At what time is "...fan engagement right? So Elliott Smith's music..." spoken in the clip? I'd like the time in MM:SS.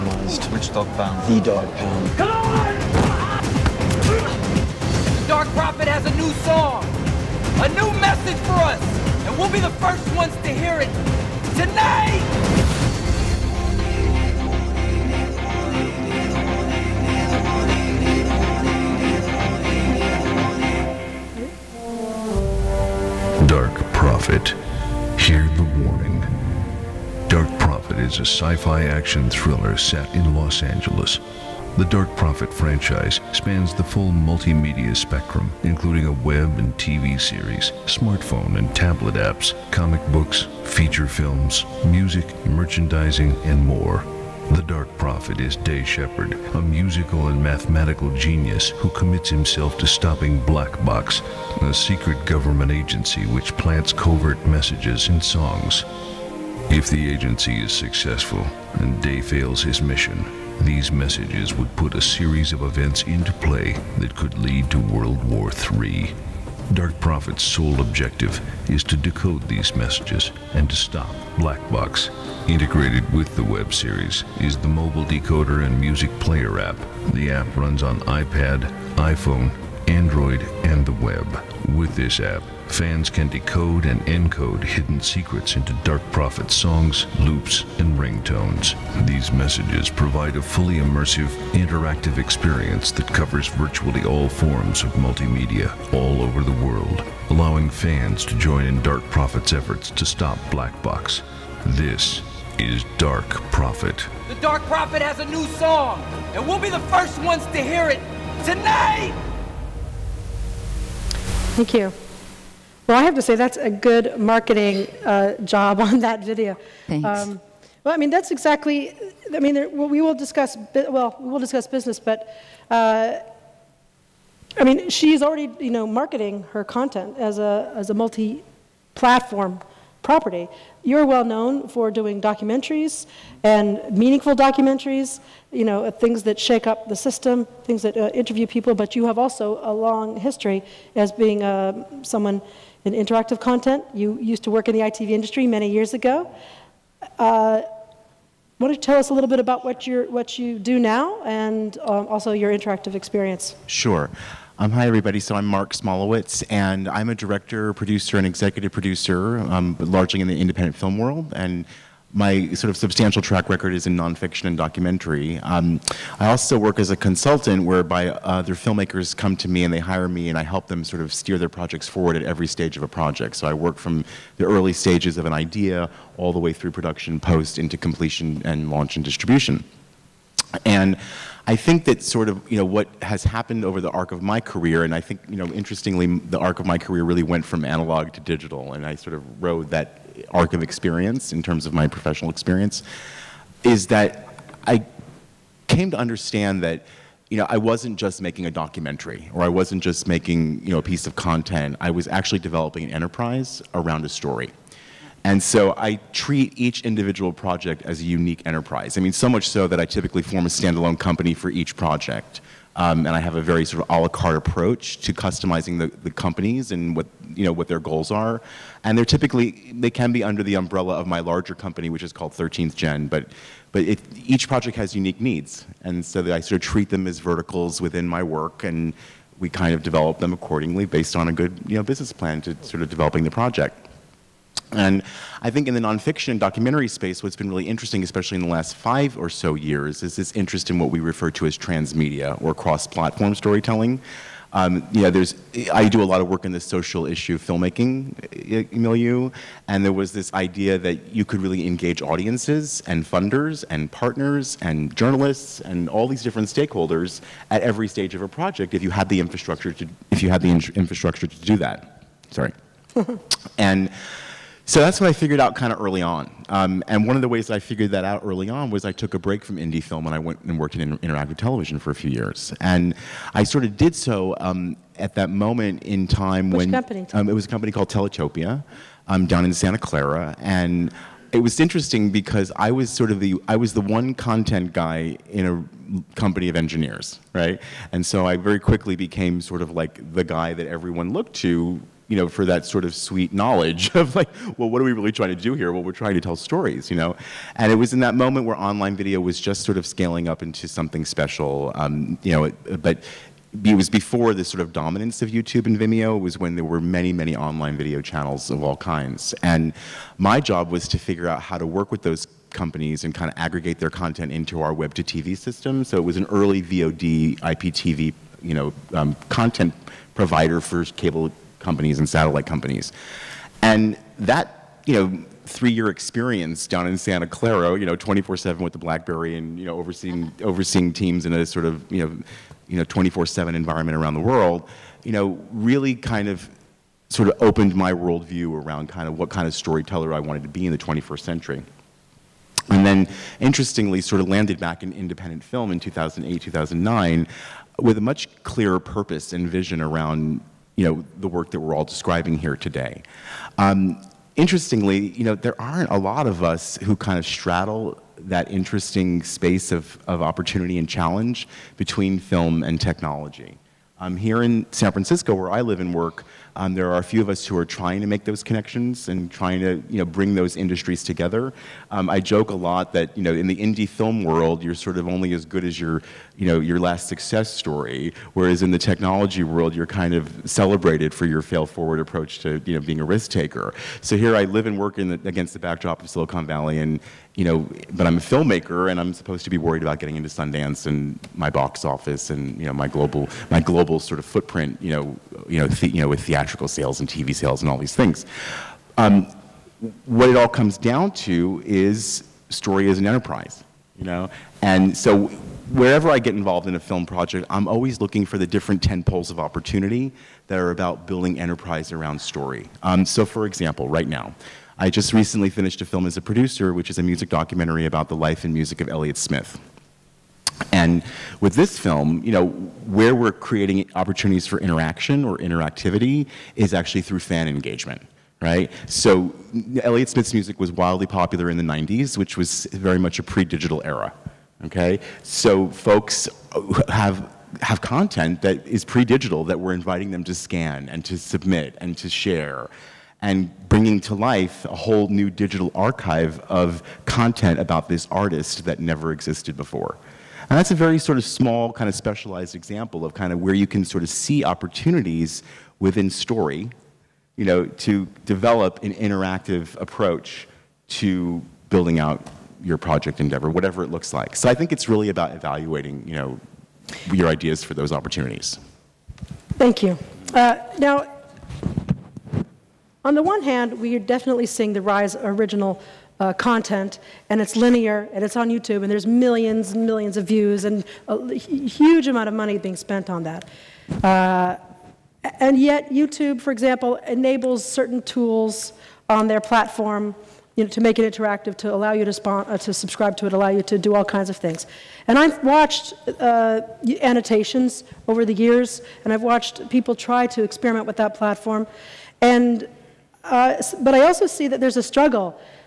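07:07.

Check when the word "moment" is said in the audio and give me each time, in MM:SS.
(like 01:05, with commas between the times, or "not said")
04:35, 04:58.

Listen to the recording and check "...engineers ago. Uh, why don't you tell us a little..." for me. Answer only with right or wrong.
wrong.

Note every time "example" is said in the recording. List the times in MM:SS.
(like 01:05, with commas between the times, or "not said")
06:53, 07:32, 08:06.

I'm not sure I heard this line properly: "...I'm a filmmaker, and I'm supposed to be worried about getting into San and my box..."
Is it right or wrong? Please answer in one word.
wrong.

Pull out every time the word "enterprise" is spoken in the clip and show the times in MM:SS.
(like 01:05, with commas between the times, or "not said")
03:22, 03:28, 06:43, 06:51.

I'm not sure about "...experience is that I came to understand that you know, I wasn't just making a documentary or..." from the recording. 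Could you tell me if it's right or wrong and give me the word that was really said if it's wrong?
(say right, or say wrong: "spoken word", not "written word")
right.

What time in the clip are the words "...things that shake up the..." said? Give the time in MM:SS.
02:15.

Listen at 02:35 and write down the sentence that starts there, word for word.
So I'm Marc Smolowitz, and I'm a director, producer, and executive producer, um, largely in the independent film world.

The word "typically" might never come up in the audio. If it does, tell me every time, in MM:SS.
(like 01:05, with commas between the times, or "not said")
03:29, 03:39.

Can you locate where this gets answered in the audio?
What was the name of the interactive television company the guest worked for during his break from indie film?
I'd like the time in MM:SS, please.
04:37.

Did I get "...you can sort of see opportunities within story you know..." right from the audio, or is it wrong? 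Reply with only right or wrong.
right.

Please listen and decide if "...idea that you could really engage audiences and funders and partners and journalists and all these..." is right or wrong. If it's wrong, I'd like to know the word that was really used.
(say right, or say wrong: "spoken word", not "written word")
right.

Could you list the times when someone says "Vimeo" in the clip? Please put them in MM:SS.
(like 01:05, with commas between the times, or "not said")
05:05.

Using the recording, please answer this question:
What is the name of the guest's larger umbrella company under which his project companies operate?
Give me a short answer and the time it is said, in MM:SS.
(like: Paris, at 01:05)
13th Gen, at 03:42.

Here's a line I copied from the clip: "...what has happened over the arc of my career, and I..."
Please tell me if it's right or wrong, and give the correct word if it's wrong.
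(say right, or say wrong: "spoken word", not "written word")
right.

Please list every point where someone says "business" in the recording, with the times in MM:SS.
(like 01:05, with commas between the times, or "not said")
02:01, 03:51.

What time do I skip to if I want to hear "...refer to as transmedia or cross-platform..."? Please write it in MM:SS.
04:00.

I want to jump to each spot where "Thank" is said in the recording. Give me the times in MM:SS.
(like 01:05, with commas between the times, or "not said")
01:51, 01:56, 07:49.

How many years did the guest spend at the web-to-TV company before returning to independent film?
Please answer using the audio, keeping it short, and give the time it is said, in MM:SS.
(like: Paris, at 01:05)
3, at 05:25.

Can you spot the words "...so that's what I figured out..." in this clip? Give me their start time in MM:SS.
04:24.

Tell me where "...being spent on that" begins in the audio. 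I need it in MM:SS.
08:02.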